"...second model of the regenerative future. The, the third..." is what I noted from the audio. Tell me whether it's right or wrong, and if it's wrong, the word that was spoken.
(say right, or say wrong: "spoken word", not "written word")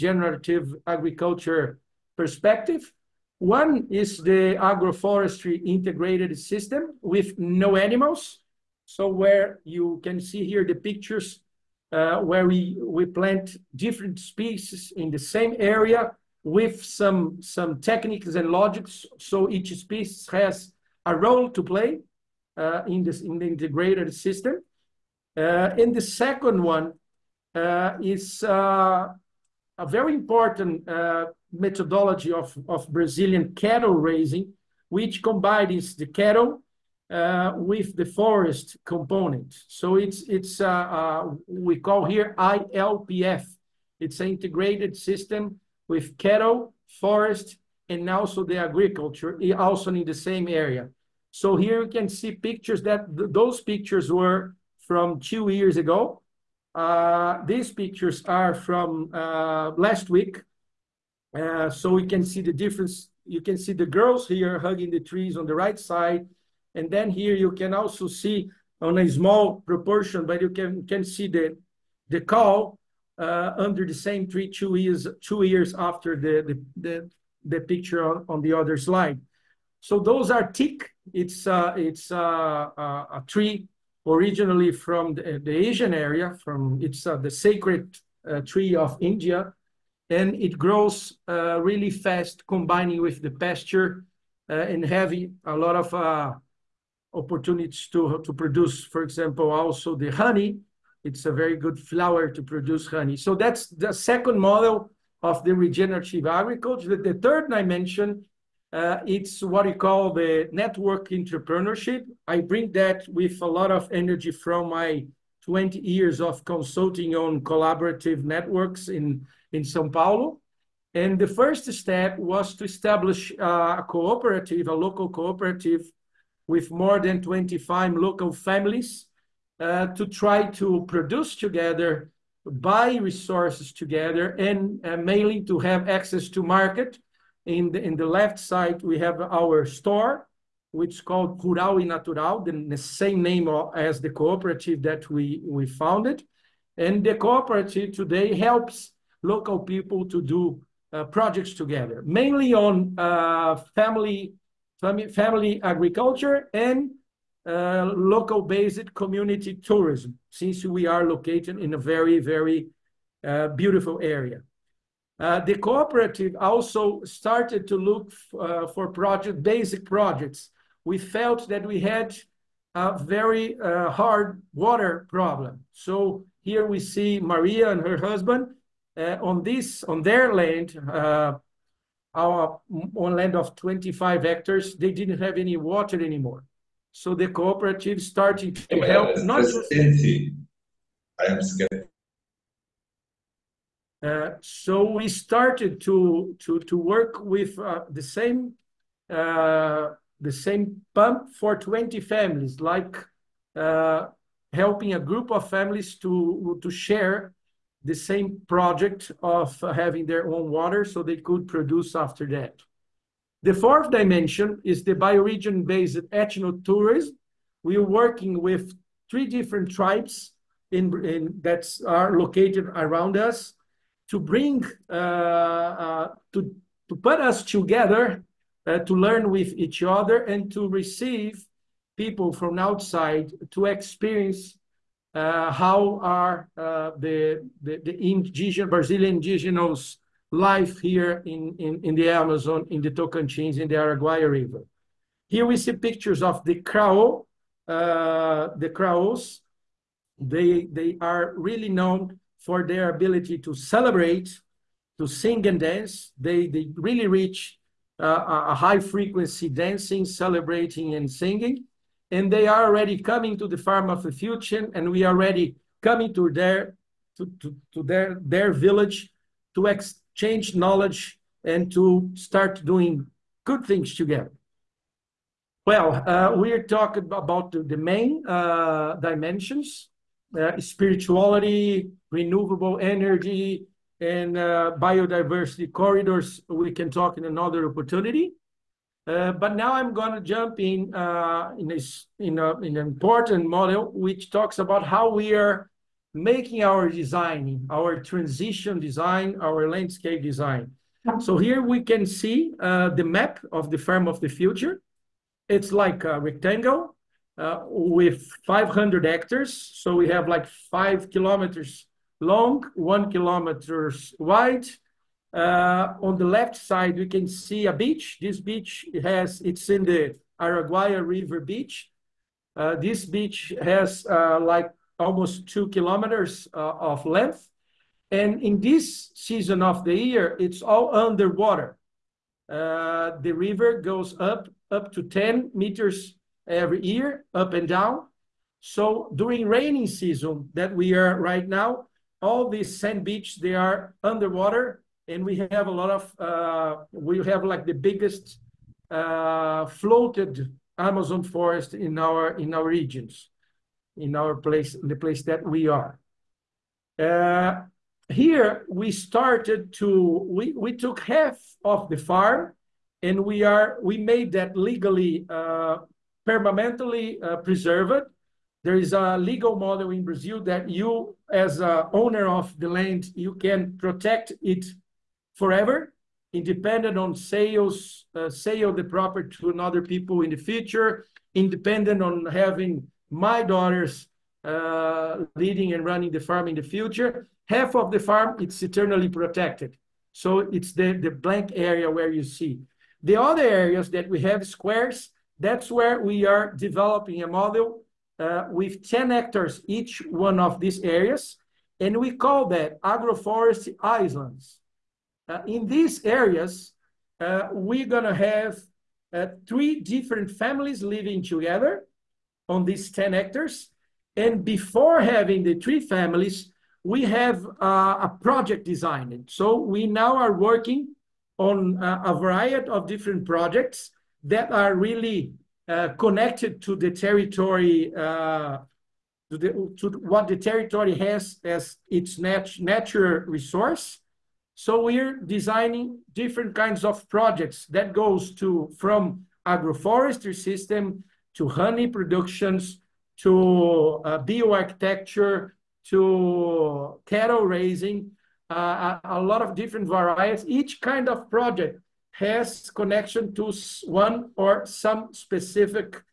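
wrong: "agriculture", not "future".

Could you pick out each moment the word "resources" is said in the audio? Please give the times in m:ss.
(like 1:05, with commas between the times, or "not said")
2:12, 7:13.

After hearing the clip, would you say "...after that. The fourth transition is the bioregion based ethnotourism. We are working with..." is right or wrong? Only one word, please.
wrong.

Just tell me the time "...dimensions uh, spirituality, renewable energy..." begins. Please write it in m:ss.
4:38.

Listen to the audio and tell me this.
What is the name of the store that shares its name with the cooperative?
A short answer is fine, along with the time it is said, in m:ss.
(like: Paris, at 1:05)
Curau e Natural, at 2:21.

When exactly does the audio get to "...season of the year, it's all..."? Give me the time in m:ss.
5:29.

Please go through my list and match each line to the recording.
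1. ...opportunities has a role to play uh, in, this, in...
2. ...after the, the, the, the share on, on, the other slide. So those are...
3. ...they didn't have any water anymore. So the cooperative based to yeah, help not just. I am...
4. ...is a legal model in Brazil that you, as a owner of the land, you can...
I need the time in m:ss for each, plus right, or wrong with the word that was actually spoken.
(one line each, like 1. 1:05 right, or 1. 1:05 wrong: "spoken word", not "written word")
1. 0:19 wrong: "species", not "opportunities"
2. 1:15 wrong: "picture", not "share"
3. 3:04 wrong: "started", not "based"
4. 6:08 right.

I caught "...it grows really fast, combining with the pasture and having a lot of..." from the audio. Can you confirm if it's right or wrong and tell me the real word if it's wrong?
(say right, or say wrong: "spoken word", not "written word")
right.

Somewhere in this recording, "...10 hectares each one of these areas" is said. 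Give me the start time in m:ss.
6:38.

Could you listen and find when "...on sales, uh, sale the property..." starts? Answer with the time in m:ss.
6:16.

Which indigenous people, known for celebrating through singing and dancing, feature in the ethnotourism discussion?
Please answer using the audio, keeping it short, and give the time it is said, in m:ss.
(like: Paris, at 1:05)
Krahô, at 4:06.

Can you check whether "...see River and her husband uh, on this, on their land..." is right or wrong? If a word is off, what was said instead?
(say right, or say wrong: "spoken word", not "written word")
wrong: "Maria", not "River".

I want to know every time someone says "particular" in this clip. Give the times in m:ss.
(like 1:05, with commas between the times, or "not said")
not said.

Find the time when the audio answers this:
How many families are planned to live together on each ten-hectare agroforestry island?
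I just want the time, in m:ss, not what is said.
6:49.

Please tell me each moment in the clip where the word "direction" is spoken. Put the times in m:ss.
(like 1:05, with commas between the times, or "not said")
not said.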